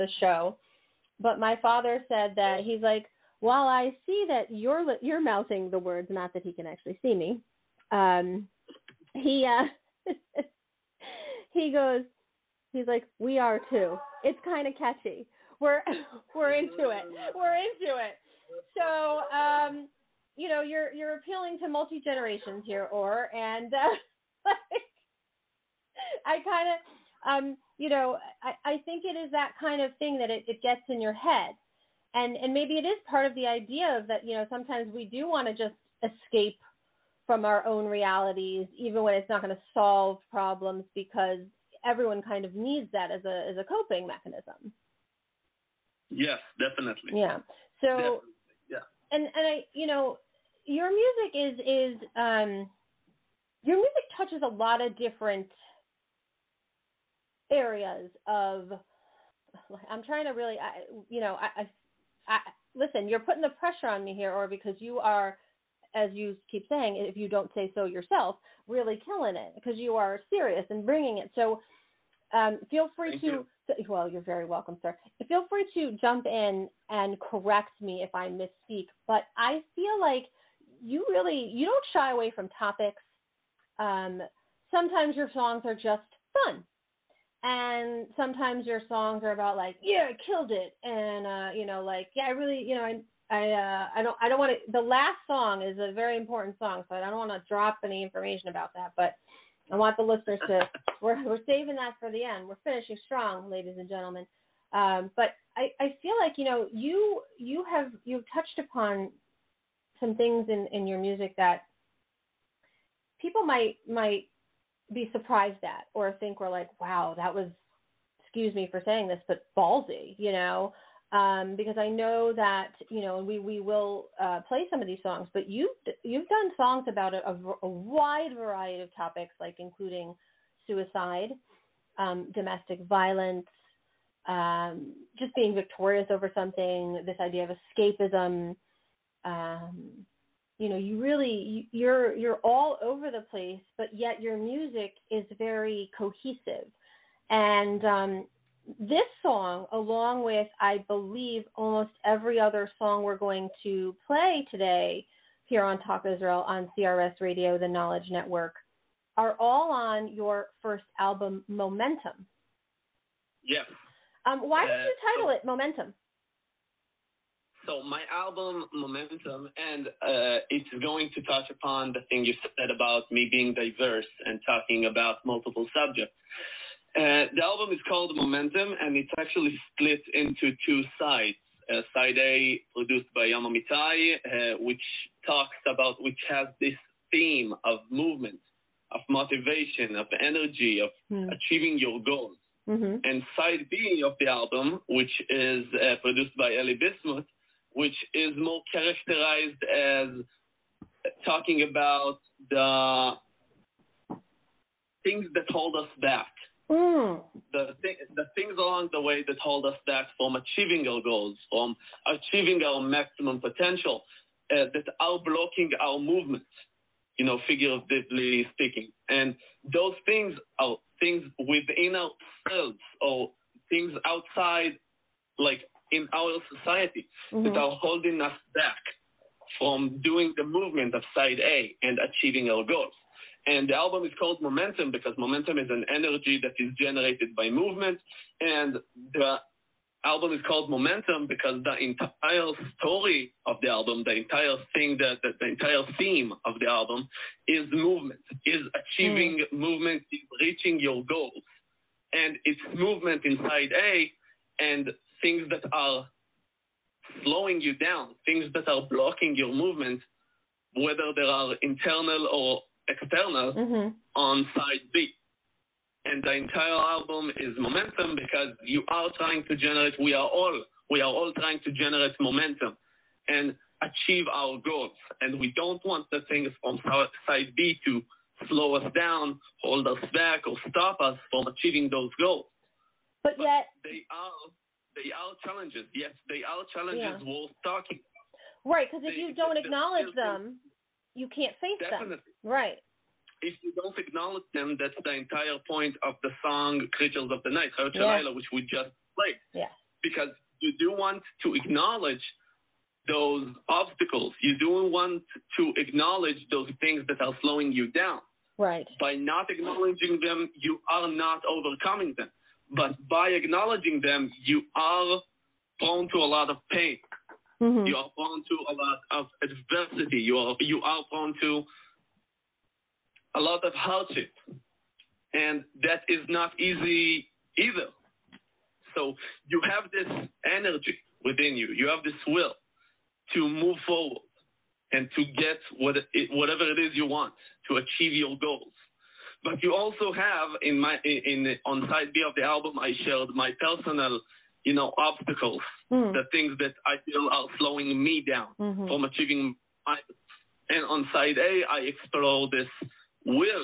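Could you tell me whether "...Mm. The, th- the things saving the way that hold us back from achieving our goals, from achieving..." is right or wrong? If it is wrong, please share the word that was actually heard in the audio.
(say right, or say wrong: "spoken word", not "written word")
wrong: "along", not "saving".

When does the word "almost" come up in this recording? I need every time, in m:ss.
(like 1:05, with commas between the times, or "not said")
2:31.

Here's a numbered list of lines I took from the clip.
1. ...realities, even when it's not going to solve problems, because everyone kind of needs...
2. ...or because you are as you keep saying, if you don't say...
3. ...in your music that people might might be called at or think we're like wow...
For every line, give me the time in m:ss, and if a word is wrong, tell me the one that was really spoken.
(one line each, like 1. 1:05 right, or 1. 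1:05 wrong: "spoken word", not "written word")
1. 0:37 right
2. 1:04 right
3. 1:50 wrong: "surprised", not "called".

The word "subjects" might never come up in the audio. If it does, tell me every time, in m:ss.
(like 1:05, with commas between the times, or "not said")
2:55.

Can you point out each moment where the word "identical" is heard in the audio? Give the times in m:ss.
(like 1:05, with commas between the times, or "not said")
not said.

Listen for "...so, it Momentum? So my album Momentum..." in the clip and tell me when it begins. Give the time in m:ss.
2:45.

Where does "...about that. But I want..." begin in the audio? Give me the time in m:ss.
1:38.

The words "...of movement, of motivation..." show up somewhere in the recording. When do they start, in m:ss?
3:07.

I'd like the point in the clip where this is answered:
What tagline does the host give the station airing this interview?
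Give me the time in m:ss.
2:37.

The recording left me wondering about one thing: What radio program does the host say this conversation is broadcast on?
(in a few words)
Talk Israel.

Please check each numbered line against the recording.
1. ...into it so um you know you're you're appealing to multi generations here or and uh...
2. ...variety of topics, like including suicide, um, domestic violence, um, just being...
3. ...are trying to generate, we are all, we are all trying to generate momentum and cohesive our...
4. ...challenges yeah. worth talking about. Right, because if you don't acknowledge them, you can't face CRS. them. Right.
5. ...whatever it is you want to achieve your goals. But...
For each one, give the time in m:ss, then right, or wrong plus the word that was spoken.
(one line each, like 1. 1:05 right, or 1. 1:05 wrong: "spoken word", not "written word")
1. 0:17 right
2. 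2:08 right
3. 4:28 wrong: "achieve", not "cohesive"
4. 4:46 wrong: "Definitely", not "CRS"
5. 5:36 right.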